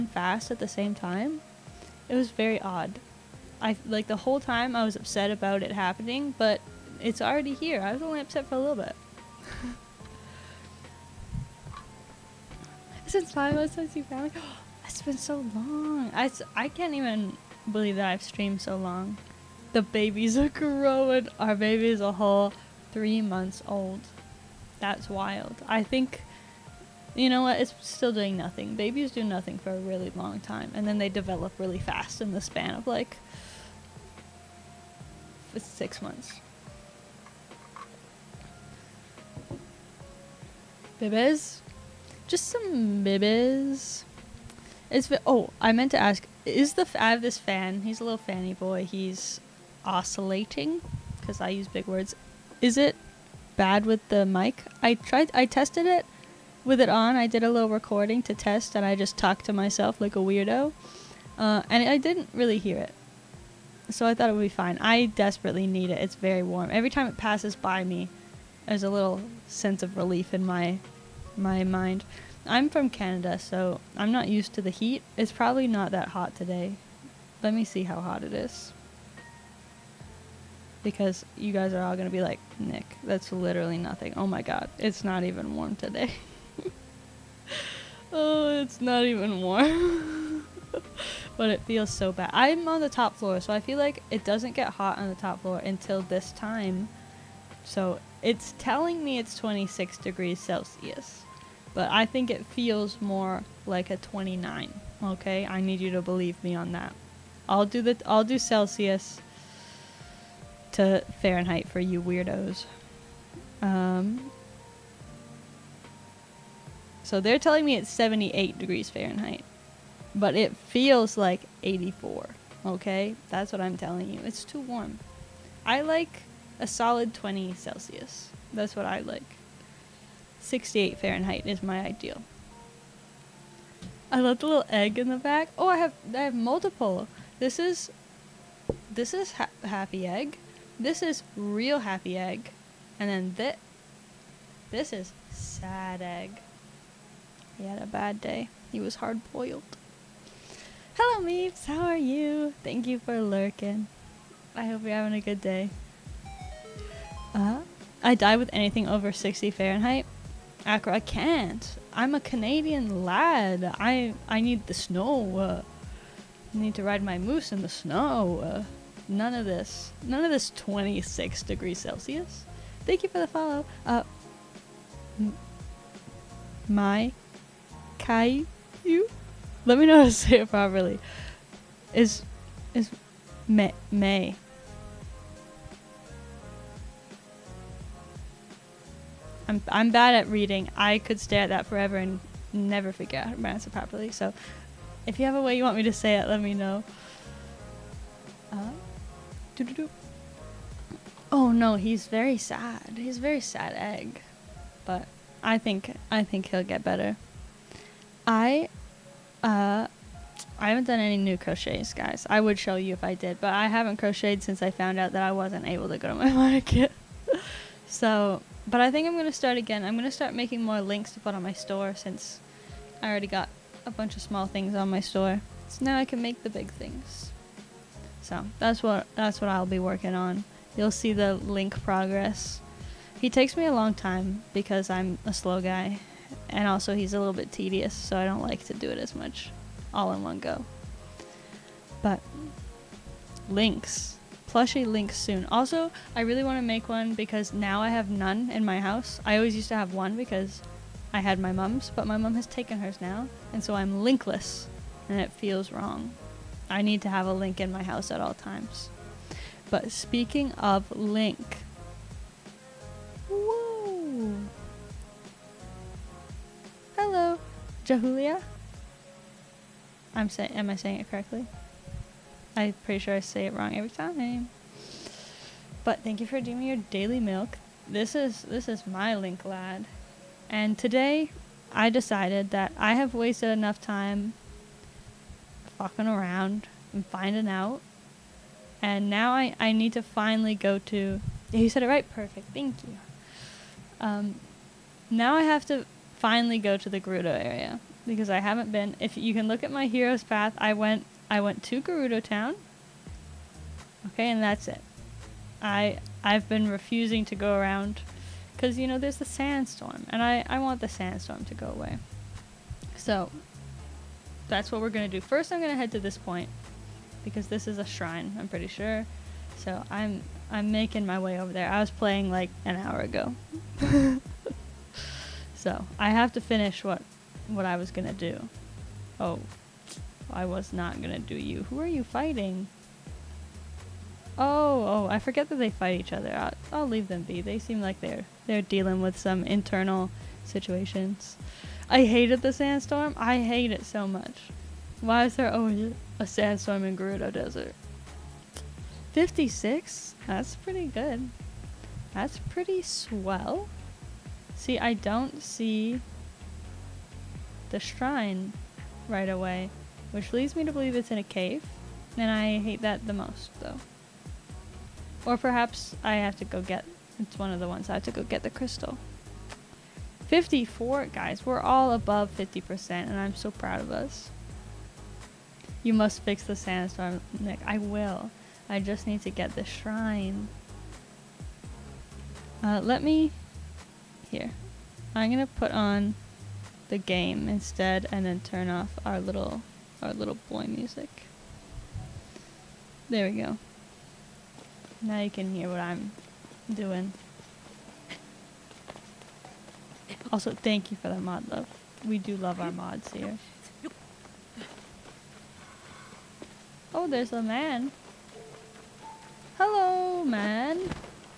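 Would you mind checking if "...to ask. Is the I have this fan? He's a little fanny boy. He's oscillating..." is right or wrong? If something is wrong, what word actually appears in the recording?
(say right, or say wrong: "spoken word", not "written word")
right.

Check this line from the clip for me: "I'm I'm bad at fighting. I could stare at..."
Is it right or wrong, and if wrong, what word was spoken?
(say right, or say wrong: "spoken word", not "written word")
wrong: "reading", not "fighting".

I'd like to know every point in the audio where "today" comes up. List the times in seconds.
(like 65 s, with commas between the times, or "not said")
76 s, 85 s, 280 s.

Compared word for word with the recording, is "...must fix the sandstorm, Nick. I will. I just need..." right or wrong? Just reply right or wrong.
right.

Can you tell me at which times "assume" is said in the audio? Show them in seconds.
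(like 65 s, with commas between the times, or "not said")
not said.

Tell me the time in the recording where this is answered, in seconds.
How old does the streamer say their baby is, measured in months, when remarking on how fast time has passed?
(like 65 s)
22 s.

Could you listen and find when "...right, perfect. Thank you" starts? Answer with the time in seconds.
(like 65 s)
291 s.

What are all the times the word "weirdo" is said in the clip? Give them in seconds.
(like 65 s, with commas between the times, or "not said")
60 s, 112 s.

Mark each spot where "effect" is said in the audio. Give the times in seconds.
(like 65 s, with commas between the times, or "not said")
not said.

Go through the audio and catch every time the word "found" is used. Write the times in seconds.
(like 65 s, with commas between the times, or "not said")
14 s, 214 s.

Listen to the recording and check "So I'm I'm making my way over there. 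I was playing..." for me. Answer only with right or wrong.
right.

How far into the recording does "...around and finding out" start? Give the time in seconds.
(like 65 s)
286 s.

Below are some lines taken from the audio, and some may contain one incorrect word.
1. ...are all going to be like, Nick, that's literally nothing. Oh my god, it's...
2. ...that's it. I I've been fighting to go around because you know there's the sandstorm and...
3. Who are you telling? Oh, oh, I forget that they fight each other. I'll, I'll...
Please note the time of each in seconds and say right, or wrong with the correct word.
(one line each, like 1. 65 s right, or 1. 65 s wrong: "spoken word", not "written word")
1. 81 s right
2. 304 s wrong: "refusing", not "fighting"
3. 331 s wrong: "fighting", not "telling".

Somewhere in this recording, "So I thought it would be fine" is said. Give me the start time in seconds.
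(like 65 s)
63 s.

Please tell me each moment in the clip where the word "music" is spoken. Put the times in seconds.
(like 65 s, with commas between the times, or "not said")
390 s.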